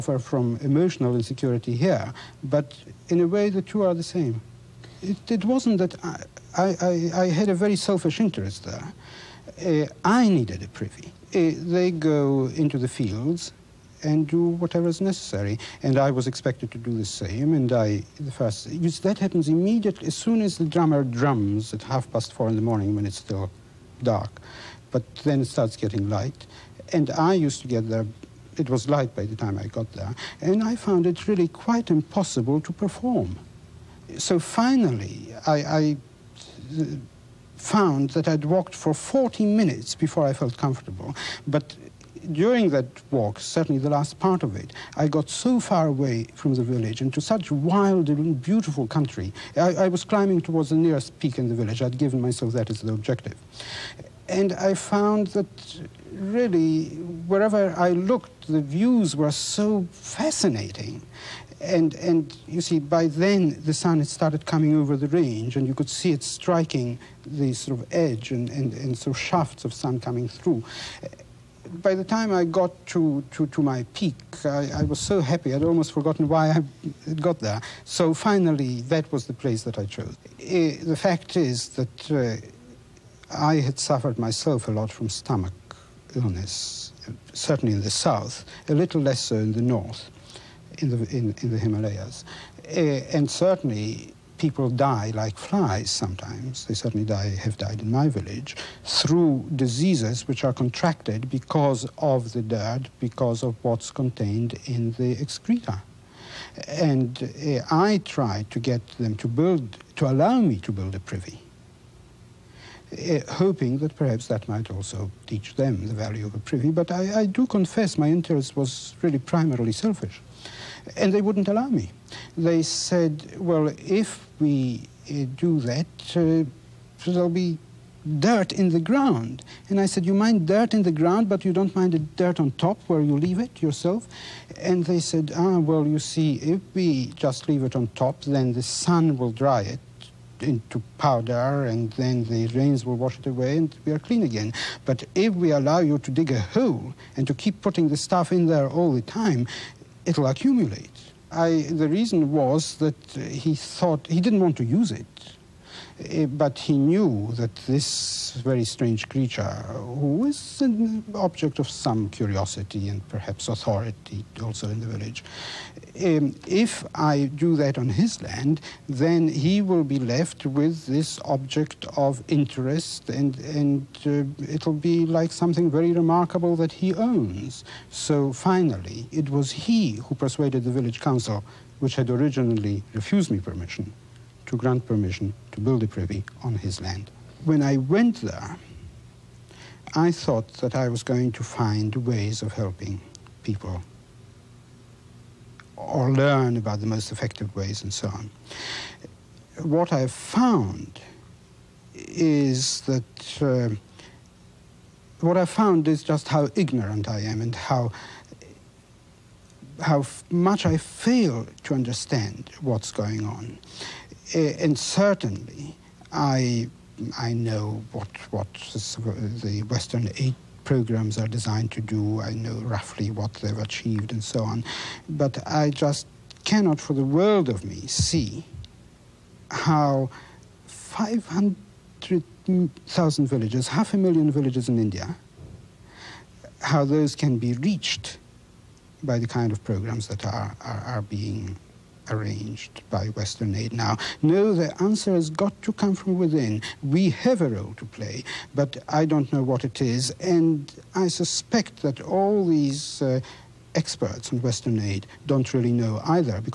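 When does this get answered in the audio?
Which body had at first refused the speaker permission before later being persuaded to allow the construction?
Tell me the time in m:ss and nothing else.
3:00.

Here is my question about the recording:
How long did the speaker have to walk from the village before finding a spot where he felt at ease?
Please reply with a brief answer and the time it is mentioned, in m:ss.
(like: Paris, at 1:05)
40 minutes, at 0:38.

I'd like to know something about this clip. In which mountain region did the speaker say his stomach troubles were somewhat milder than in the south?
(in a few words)
Himalayas.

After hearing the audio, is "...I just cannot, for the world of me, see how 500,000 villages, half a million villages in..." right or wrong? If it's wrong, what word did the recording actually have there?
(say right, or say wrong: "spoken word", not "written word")
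right.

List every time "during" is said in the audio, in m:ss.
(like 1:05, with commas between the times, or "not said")
0:42.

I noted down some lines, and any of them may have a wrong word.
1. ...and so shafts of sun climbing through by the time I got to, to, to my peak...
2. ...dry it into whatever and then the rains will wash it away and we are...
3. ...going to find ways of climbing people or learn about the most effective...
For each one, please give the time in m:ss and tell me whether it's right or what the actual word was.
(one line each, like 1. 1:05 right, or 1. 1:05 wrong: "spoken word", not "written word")
1. 1:08 wrong: "coming", not "climbing"
2. 2:19 wrong: "powder", not "whatever"
3. 3:11 wrong: "helping", not "climbing".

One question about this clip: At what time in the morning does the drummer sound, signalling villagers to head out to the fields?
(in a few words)
4:30.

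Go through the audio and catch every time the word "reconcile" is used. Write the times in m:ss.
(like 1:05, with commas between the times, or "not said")
not said.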